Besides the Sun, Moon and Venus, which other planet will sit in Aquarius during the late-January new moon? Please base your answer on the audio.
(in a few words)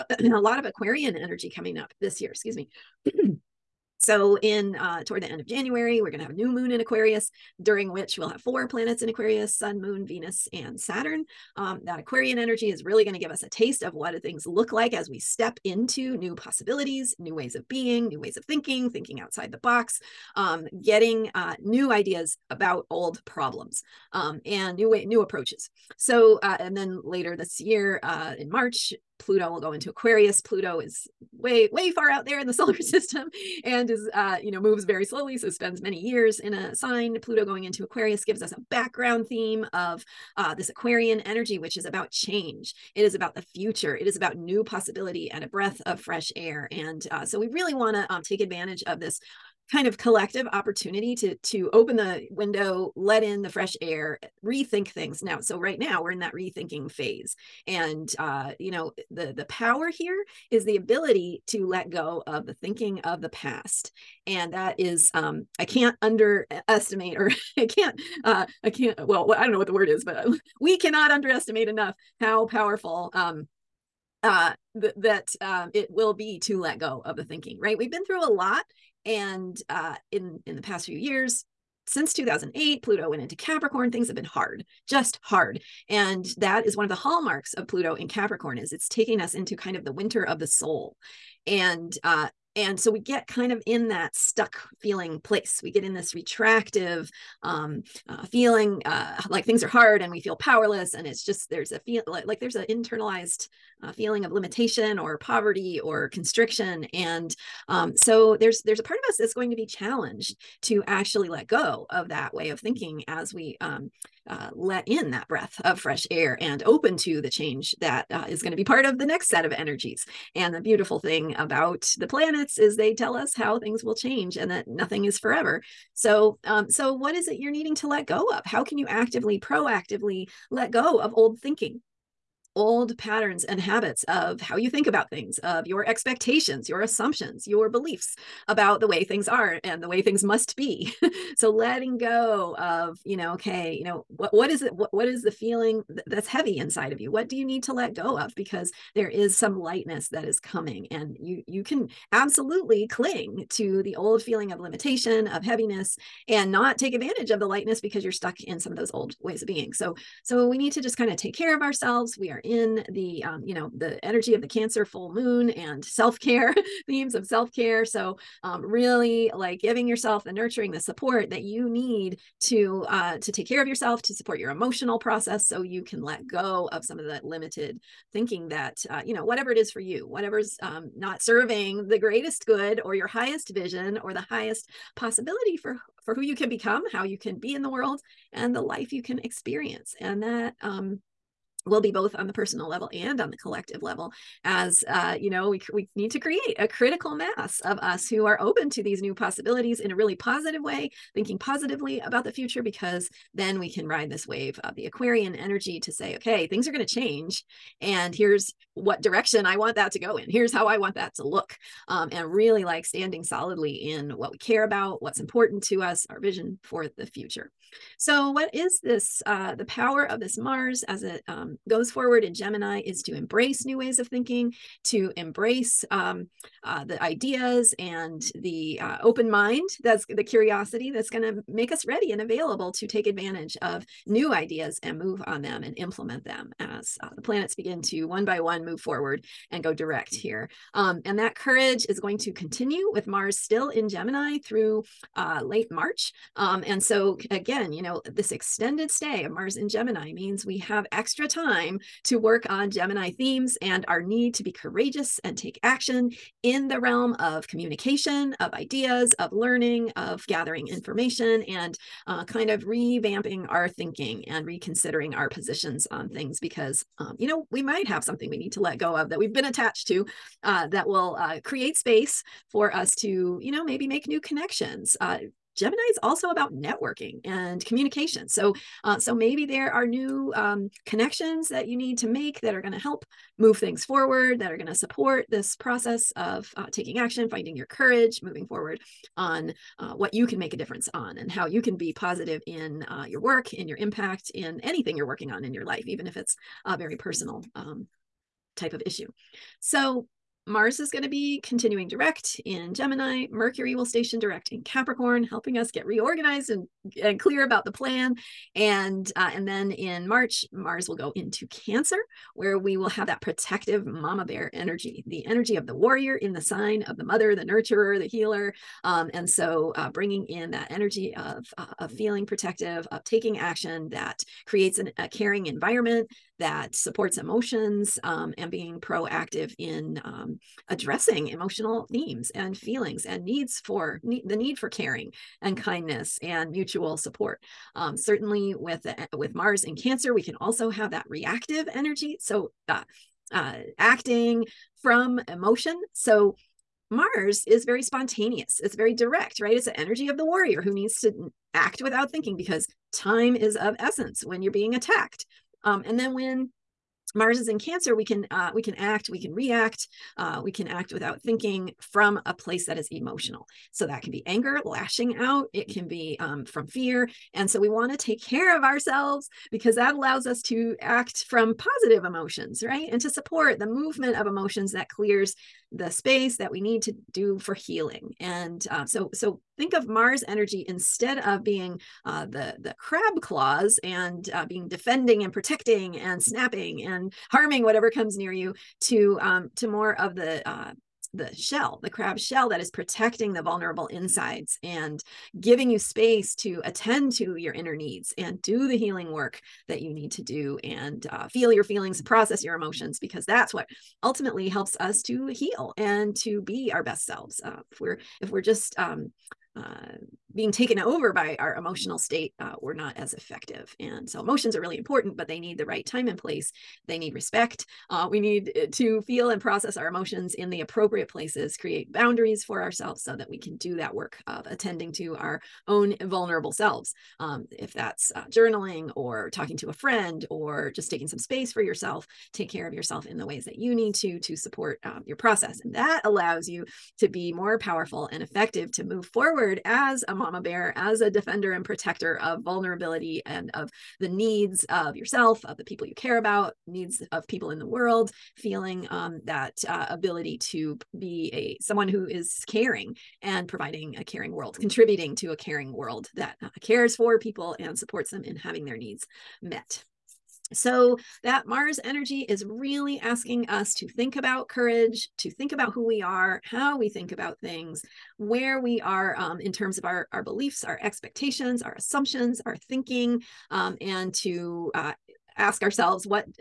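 Saturn.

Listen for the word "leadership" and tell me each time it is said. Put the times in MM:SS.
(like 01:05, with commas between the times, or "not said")
not said.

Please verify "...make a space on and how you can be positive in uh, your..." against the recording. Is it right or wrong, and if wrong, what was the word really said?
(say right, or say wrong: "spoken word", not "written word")
wrong: "difference", not "space".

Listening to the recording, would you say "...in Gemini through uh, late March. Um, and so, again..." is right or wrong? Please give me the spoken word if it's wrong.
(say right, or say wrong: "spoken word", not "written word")
right.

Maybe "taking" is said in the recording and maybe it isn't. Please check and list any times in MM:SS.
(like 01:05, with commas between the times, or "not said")
01:28, 04:46, 05:23, 07:10.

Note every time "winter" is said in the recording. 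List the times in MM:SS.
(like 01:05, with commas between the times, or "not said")
01:29.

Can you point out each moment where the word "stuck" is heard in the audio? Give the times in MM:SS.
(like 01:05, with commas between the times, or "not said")
01:34, 02:38.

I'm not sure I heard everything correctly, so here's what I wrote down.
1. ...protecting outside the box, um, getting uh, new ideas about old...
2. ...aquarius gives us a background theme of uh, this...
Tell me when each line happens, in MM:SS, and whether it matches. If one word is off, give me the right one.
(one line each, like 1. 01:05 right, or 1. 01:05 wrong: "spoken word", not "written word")
1. 00:18 wrong: "thinking", not "protecting"
2. 00:37 right.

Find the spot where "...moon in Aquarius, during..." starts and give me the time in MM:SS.
00:06.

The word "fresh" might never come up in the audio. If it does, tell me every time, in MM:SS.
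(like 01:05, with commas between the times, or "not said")
00:45, 00:53, 01:55.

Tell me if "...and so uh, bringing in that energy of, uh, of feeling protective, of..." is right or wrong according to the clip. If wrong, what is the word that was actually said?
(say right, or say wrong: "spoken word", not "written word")
right.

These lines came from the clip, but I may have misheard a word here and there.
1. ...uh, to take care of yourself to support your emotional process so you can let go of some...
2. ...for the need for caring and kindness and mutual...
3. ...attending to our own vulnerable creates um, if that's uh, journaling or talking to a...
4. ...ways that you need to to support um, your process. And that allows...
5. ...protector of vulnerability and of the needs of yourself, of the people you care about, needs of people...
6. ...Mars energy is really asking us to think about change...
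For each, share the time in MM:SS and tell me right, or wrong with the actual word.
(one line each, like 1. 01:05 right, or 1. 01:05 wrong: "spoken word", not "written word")
1. 02:52 right
2. 05:33 right
3. 07:04 wrong: "selves", not "creates"
4. 07:13 right
5. 07:21 right
6. 07:41 wrong: "courage", not "change".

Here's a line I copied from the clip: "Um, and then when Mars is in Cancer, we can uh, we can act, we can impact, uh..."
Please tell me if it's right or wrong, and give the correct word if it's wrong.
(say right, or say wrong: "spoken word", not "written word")
wrong: "react", not "impact".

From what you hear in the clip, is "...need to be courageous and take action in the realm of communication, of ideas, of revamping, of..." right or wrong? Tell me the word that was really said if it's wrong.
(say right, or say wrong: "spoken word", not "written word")
wrong: "learning", not "revamping".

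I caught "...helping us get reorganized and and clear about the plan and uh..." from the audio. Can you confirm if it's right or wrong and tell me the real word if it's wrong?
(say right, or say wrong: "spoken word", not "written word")
right.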